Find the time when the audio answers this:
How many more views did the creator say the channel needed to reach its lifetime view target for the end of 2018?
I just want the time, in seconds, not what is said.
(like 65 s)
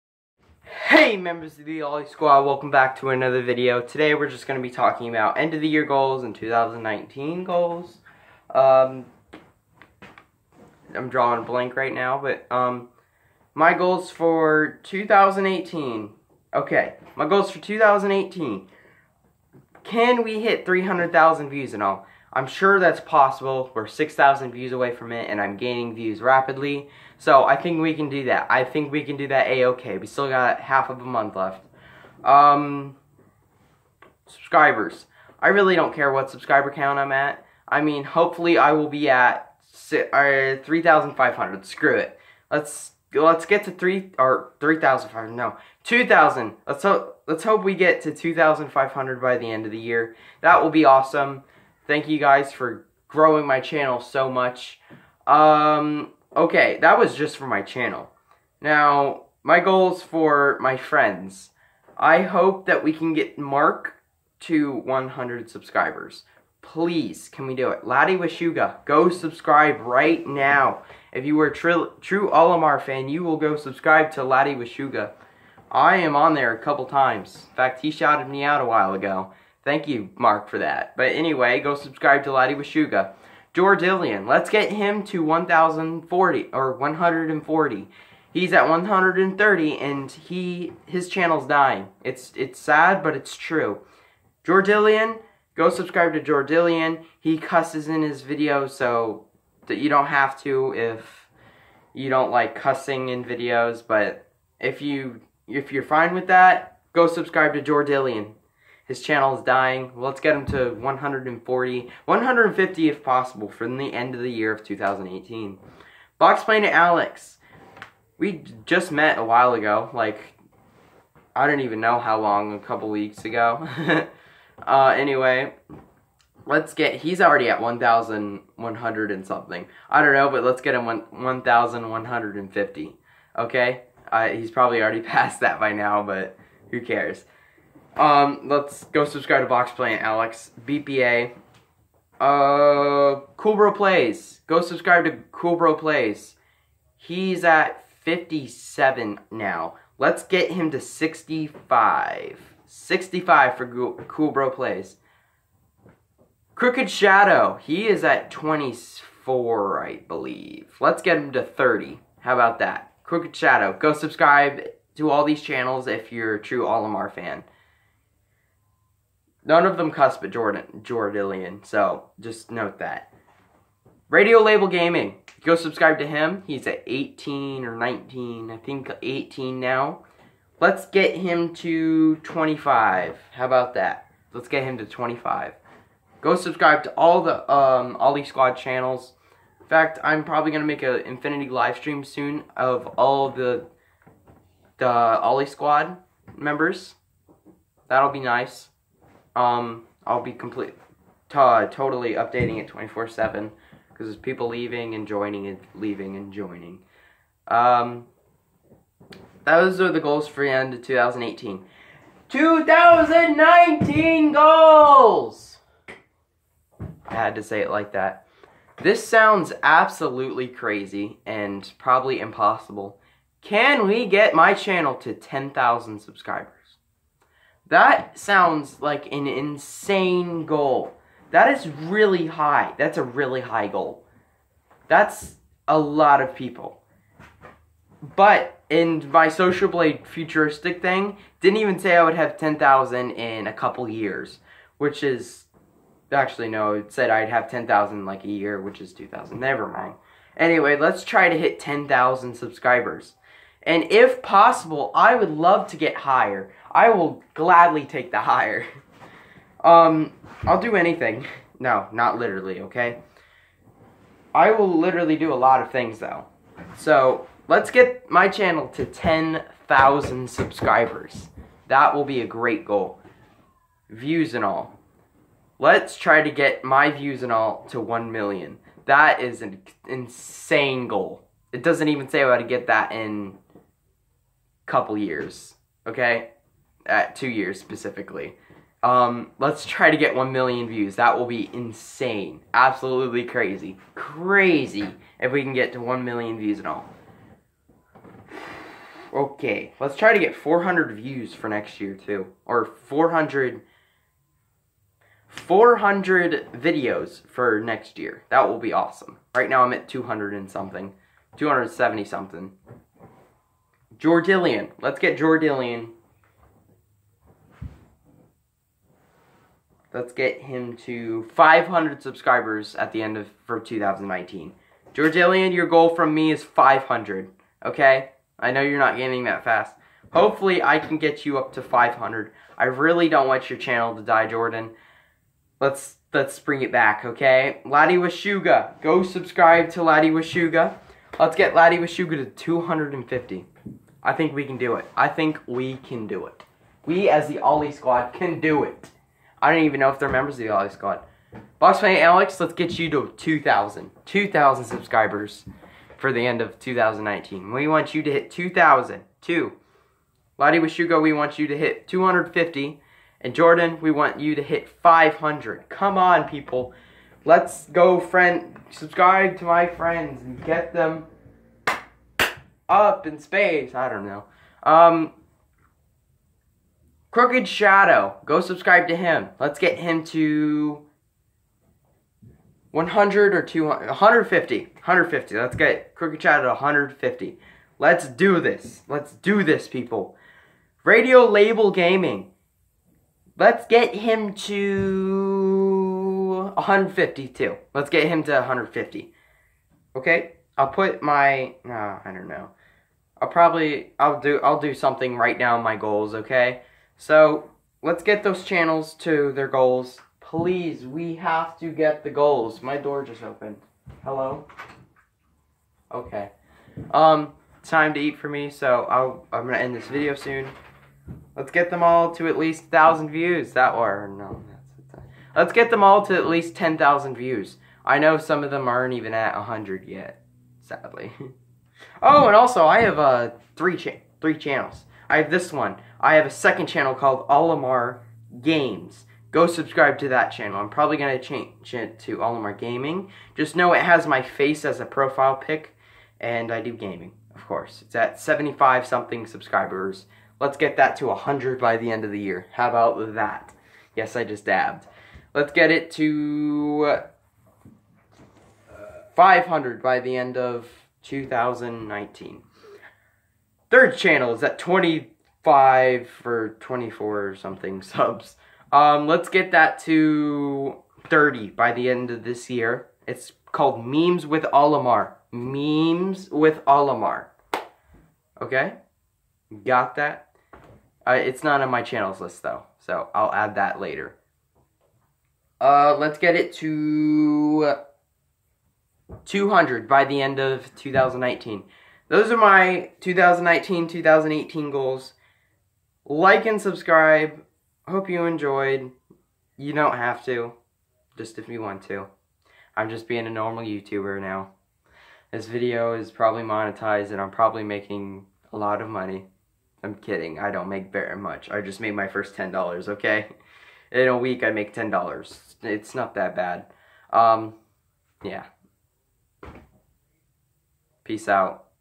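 23 s.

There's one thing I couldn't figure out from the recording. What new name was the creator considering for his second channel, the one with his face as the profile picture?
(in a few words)
Olimar Gaming.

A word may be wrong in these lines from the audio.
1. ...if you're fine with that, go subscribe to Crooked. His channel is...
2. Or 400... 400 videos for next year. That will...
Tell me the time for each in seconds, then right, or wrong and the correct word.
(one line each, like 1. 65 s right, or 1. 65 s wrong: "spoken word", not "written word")
1. 105 s wrong: "Jordilian", not "Crooked"
2. 302 s right.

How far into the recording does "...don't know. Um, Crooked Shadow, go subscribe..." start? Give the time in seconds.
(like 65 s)
373 s.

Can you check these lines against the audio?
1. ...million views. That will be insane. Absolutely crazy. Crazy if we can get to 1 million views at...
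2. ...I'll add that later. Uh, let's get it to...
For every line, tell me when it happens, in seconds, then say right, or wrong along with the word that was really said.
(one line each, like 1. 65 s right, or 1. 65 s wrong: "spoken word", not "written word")
1. 290 s right
2. 483 s right.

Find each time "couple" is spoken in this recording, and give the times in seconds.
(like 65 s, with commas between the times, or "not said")
76 s, 122 s, 243 s, 284 s.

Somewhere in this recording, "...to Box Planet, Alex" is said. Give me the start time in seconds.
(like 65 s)
139 s.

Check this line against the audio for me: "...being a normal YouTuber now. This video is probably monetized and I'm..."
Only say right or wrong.
right.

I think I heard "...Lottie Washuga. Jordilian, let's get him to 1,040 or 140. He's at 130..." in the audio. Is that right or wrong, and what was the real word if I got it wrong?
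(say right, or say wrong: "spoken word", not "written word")
right.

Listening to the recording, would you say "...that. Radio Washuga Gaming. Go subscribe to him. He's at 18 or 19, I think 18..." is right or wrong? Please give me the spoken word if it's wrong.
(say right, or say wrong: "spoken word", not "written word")
wrong: "Label", not "Washuga".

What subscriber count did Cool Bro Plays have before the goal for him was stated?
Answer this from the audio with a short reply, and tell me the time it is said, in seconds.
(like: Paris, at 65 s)
57, at 148 s.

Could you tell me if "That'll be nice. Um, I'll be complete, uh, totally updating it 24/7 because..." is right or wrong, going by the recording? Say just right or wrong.
right.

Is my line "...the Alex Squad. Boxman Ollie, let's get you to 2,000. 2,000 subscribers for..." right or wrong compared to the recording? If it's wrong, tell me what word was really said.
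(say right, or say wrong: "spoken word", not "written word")
wrong: "Alex", not "Ollie".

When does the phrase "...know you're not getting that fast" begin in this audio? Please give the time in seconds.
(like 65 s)
328 s.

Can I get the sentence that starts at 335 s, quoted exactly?
Let's let's bring it back, okay?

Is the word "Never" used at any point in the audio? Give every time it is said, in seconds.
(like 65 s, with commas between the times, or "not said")
249 s.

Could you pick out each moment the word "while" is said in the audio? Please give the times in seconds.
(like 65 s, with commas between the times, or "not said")
78 s, 119 s.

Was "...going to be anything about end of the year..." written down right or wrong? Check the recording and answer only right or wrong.
wrong.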